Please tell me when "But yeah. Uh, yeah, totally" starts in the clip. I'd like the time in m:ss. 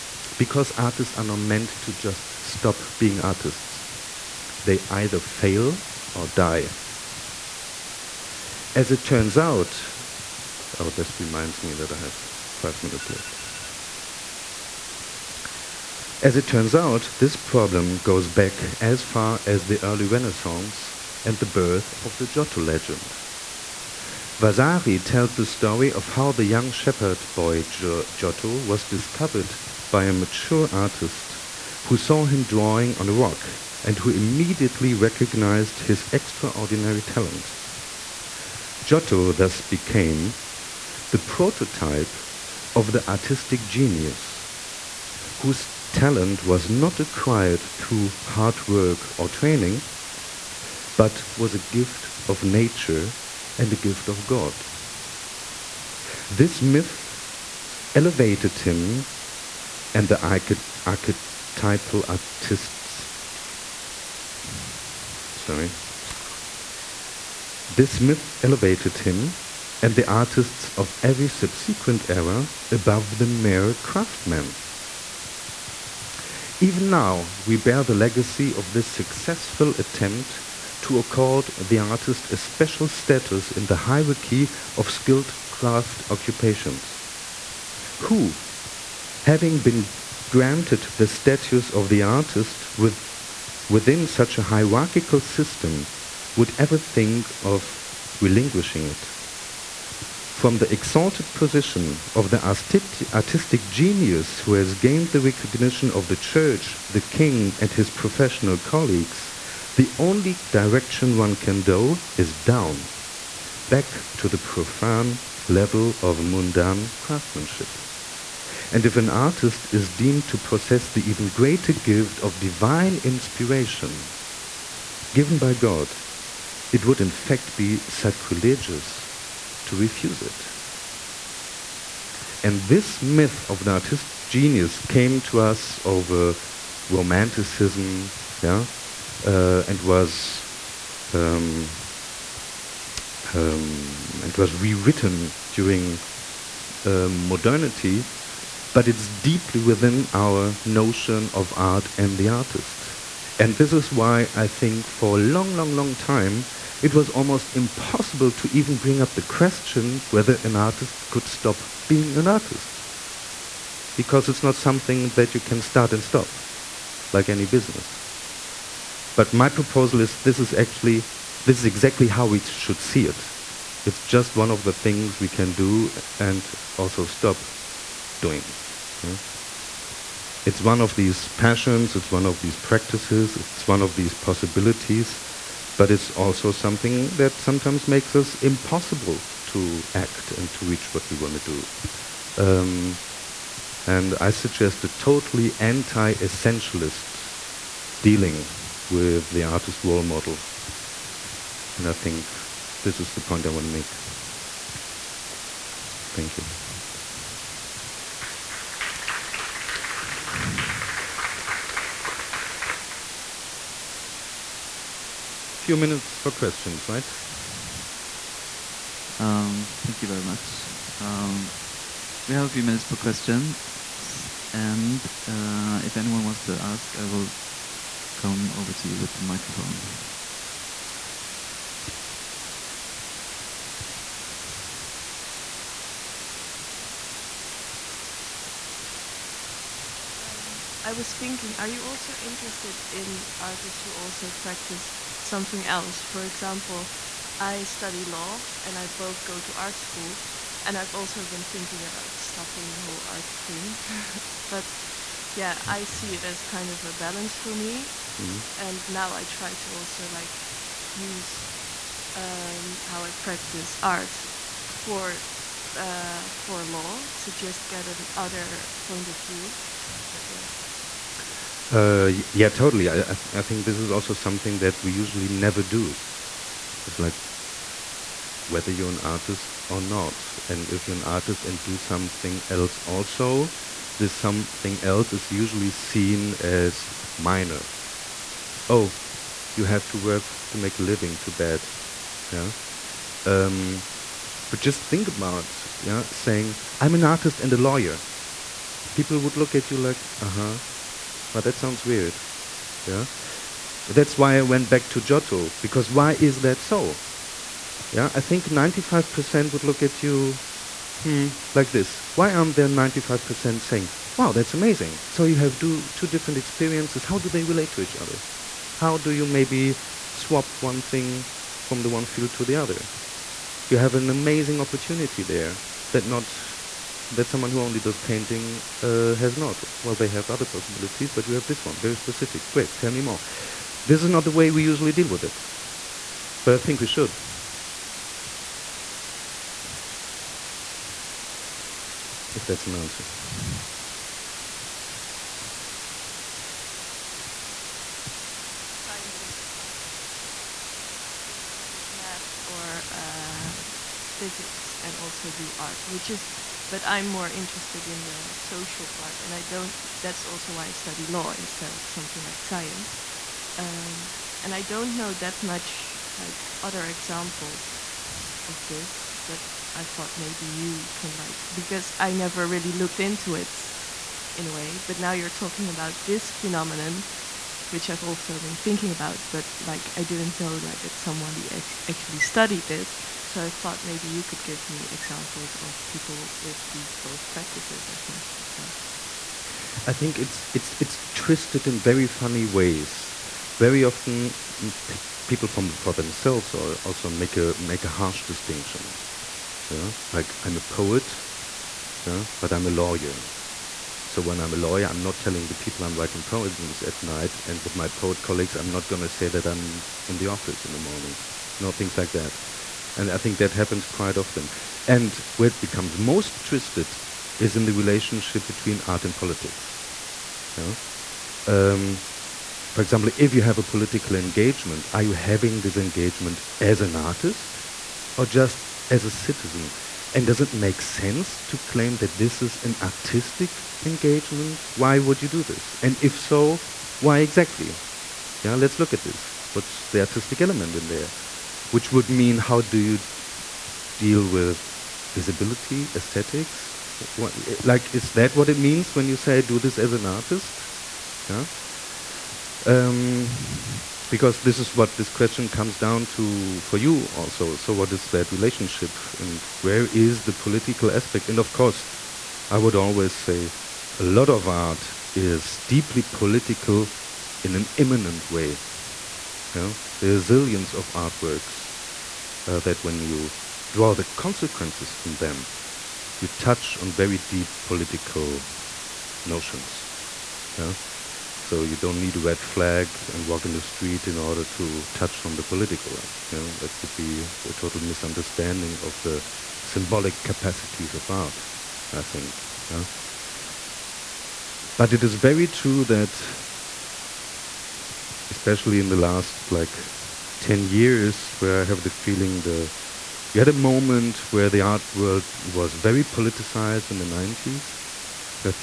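4:30.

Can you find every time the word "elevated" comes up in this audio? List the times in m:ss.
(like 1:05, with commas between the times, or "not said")
0:57, 1:08.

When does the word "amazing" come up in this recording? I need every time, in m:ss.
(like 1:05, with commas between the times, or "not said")
5:14, 5:24.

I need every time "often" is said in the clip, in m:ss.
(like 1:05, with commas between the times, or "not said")
6:33, 6:54.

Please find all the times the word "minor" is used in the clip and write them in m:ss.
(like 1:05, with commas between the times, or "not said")
4:47.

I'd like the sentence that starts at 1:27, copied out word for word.
Who, having been granted the status of the artist with, within such a hierarchical system, would ever think of relinquishing it.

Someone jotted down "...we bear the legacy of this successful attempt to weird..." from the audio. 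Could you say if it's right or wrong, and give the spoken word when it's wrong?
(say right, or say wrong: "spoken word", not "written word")
wrong: "accord", not "weird".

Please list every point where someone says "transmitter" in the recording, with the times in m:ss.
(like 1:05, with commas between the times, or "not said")
not said.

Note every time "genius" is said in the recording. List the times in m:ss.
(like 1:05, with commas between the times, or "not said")
0:43, 1:43, 2:14.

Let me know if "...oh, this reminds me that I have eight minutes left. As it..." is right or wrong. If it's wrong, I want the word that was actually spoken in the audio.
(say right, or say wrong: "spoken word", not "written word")
wrong: "five", not "eight".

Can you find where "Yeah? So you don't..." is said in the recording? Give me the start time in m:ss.
8:00.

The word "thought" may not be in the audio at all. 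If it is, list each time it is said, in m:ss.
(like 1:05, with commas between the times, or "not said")
6:09, 6:23.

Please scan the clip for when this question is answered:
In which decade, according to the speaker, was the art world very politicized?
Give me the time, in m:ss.
8:27.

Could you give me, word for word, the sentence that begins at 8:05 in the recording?
Uh, you know, that would be a total misunderstanding of the symbolic capacities of art, I think.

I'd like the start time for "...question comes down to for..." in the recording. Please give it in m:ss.
7:35.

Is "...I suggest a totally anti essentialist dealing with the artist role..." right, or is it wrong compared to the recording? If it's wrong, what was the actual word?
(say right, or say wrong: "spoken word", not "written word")
right.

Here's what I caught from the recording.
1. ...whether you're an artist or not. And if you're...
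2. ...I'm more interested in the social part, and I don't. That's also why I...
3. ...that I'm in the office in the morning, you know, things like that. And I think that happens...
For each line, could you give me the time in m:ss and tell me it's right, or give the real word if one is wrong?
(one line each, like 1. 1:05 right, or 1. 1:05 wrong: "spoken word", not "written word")
1. 4:38 right
2. 5:56 right
3. 6:49 right.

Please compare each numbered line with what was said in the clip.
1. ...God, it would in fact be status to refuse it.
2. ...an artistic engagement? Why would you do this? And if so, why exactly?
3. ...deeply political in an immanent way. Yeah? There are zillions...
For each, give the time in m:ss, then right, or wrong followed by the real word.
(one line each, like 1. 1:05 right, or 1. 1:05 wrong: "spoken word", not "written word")
1. 2:05 wrong: "sacrilegious", not "status"
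2. 7:12 right
3. 7:45 right.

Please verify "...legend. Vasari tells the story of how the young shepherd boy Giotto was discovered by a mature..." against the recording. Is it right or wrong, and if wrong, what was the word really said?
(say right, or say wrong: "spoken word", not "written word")
right.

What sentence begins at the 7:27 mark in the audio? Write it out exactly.
What, like, is that what it means when you say do this as an artist?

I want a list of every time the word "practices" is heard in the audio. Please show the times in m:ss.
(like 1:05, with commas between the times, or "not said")
3:02, 4:04, 4:23, 6:27.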